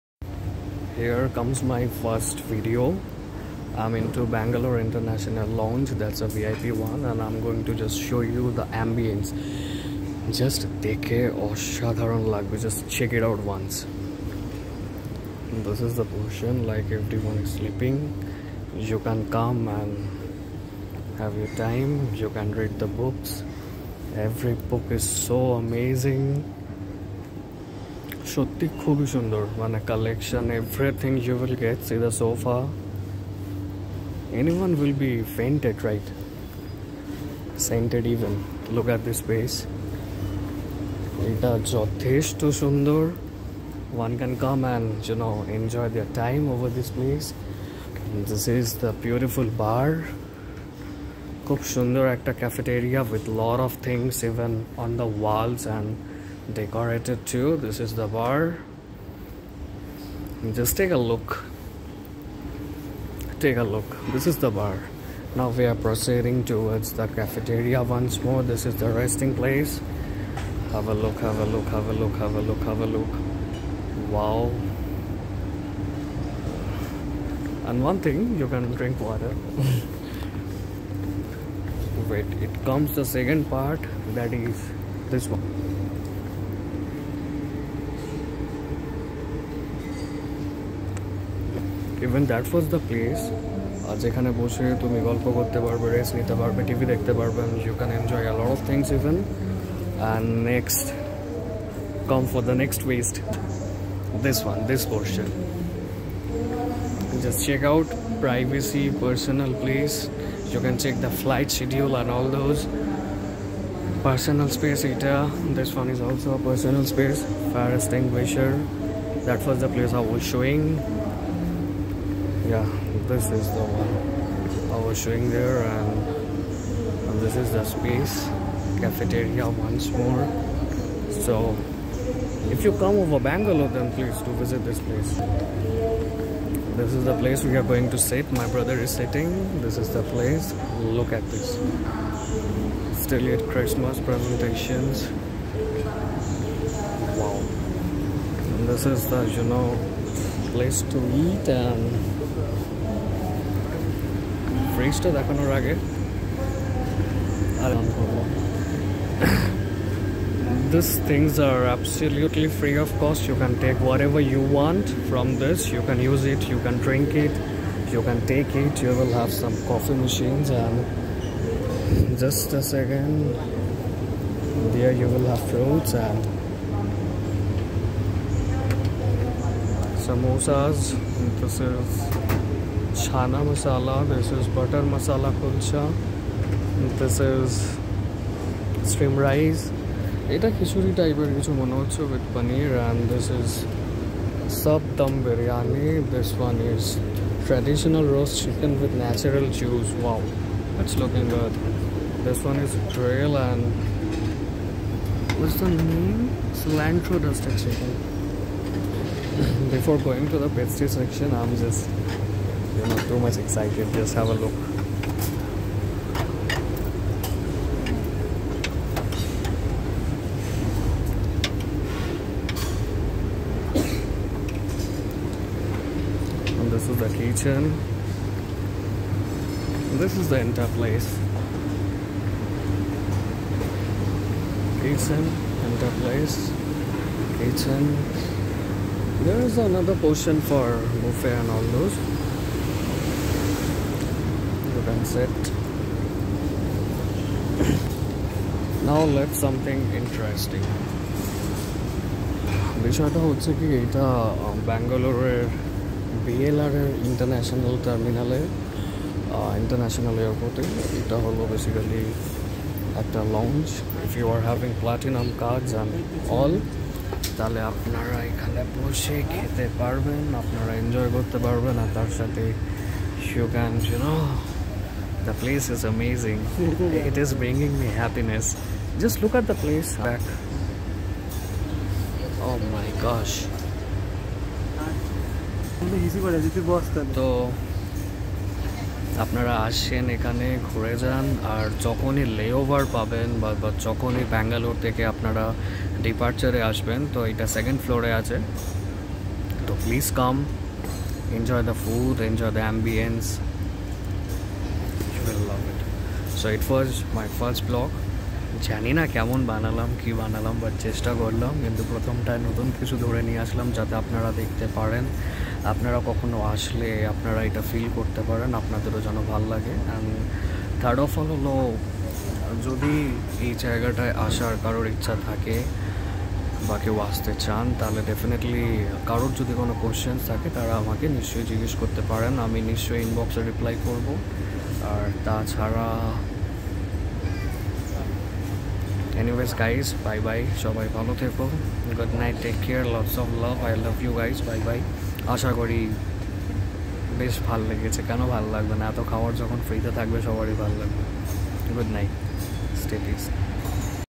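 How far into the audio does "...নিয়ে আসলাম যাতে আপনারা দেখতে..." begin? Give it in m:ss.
5:13.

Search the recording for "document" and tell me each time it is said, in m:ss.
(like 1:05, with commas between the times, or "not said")
not said.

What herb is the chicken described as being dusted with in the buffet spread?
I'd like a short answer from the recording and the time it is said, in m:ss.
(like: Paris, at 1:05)
cilantro, at 3:26.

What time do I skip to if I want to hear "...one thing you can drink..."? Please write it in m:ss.
1:17.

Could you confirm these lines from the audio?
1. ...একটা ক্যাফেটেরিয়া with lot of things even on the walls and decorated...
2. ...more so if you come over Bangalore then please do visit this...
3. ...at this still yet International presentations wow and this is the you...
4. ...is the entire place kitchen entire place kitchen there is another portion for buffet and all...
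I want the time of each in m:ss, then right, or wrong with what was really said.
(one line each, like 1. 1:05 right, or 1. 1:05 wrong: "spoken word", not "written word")
1. 0:52 right
2. 2:09 right
3. 2:21 wrong: "Christmas", not "International"
4. 3:50 right.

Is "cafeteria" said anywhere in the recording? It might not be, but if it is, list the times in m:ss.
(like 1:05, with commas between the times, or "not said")
1:07, 2:08.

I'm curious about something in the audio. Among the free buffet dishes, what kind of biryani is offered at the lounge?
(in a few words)
sab dum biryani.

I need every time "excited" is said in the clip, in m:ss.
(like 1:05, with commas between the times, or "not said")
3:33.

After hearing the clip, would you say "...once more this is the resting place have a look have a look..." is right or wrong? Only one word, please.
right.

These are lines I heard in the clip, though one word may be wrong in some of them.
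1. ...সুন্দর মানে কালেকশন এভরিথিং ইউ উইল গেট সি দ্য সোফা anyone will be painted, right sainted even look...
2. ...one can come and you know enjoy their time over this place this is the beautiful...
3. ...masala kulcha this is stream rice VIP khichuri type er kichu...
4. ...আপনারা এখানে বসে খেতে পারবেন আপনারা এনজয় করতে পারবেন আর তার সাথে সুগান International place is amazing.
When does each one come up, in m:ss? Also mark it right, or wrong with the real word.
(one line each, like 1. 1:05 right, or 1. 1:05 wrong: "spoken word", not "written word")
1. 0:29 right
2. 0:44 right
3. 3:04 wrong: "Ita", not "VIP"
4. 4:27 wrong: "The", not "International".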